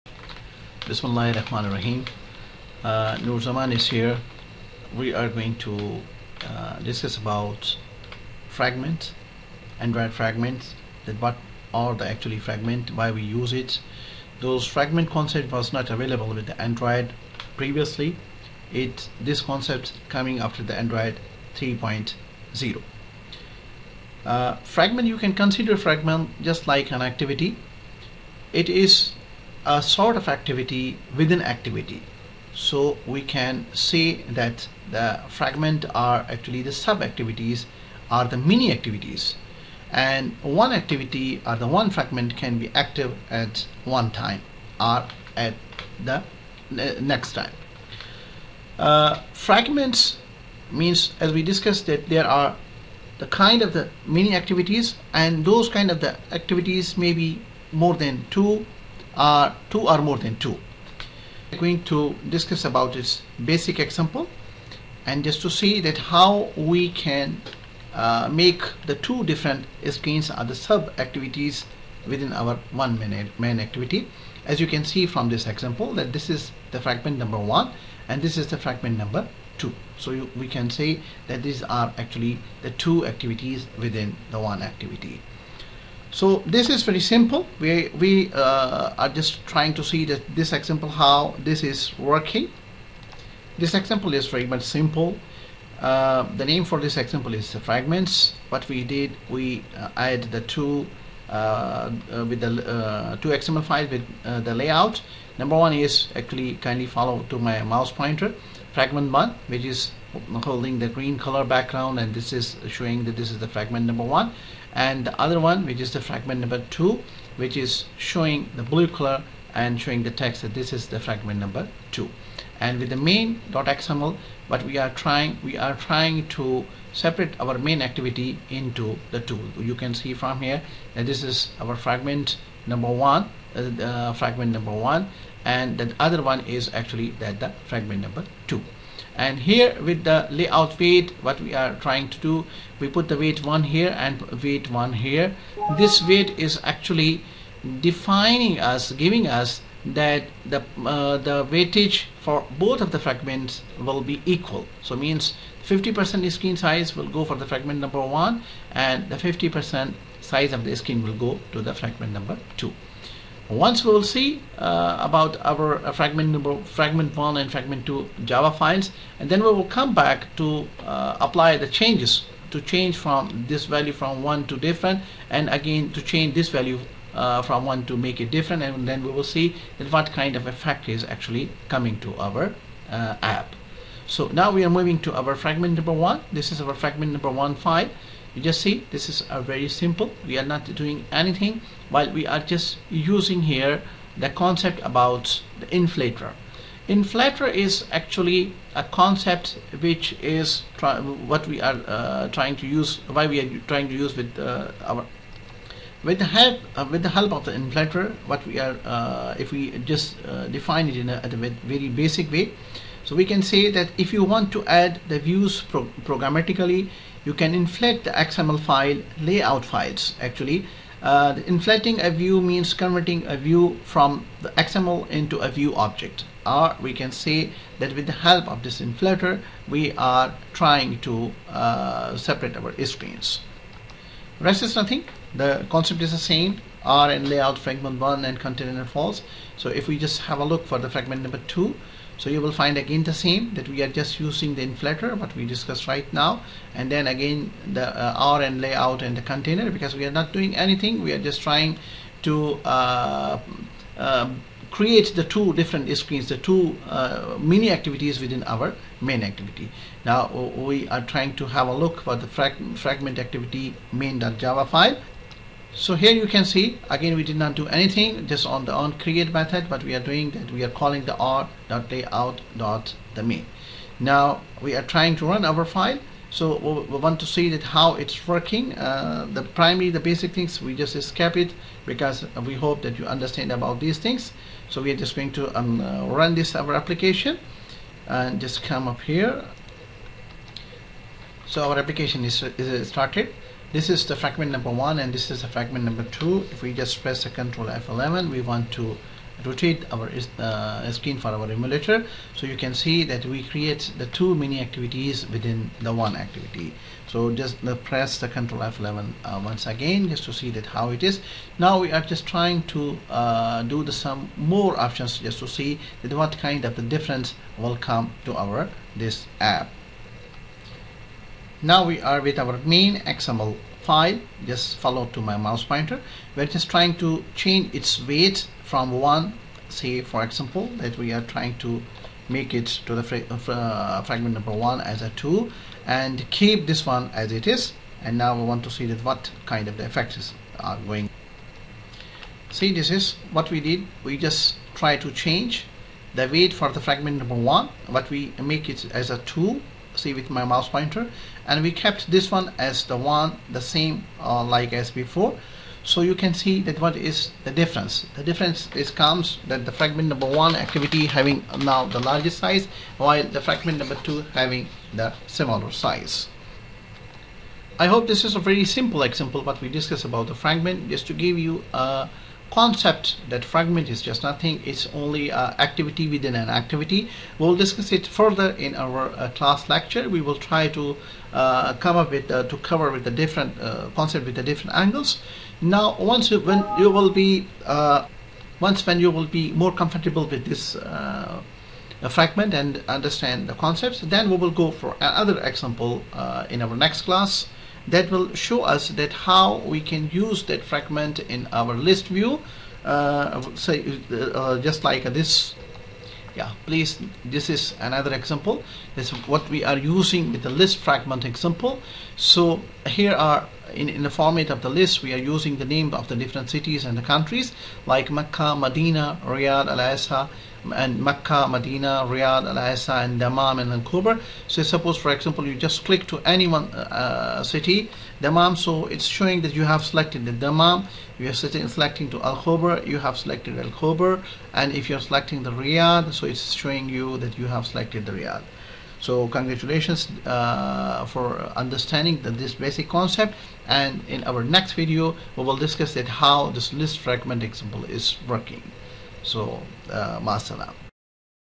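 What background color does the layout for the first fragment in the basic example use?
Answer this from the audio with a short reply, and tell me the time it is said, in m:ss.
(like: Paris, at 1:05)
Green, at 1:50.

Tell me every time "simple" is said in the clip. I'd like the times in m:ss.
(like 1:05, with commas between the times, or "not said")
1:26, 1:34, 3:09, 6:08.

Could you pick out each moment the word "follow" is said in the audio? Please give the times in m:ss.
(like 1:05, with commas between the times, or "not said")
1:46, 5:24.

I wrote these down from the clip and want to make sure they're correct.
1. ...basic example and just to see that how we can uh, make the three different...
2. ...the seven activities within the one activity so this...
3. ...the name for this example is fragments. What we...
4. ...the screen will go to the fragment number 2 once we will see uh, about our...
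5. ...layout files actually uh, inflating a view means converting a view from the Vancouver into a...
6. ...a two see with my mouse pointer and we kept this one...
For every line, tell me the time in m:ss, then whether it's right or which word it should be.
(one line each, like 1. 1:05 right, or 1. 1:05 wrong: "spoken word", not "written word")
1. 1:03 wrong: "two", not "three"
2. 1:22 wrong: "two", not "seven"
3. 1:36 right
4. 2:40 right
5. 3:39 wrong: "XML", not "Vancouver"
6. 5:49 right.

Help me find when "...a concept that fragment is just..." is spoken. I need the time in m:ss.
6:11.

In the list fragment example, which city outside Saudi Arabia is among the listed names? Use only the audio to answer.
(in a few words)
Vancouver.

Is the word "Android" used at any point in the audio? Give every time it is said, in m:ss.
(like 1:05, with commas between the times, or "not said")
0:09, 0:16, 0:20.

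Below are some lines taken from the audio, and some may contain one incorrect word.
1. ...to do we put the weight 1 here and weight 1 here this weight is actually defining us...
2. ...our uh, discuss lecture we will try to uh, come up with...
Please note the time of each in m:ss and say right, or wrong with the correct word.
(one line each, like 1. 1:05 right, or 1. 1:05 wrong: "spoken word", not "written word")
1. 2:22 right
2. 6:18 wrong: "class", not "discuss".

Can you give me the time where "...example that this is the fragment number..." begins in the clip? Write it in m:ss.
1:15.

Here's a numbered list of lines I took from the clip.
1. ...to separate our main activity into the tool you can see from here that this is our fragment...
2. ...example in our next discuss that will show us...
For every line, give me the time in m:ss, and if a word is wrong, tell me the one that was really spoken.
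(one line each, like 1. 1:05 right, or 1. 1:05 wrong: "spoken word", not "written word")
1. 2:06 right
2. 6:35 wrong: "class", not "discuss".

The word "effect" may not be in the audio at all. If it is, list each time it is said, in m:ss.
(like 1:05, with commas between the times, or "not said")
3:00, 5:39.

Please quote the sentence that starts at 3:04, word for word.
So now we are moving to our fragment number 1.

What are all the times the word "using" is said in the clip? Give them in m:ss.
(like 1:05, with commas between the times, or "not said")
3:12, 4:04, 6:49, 6:55.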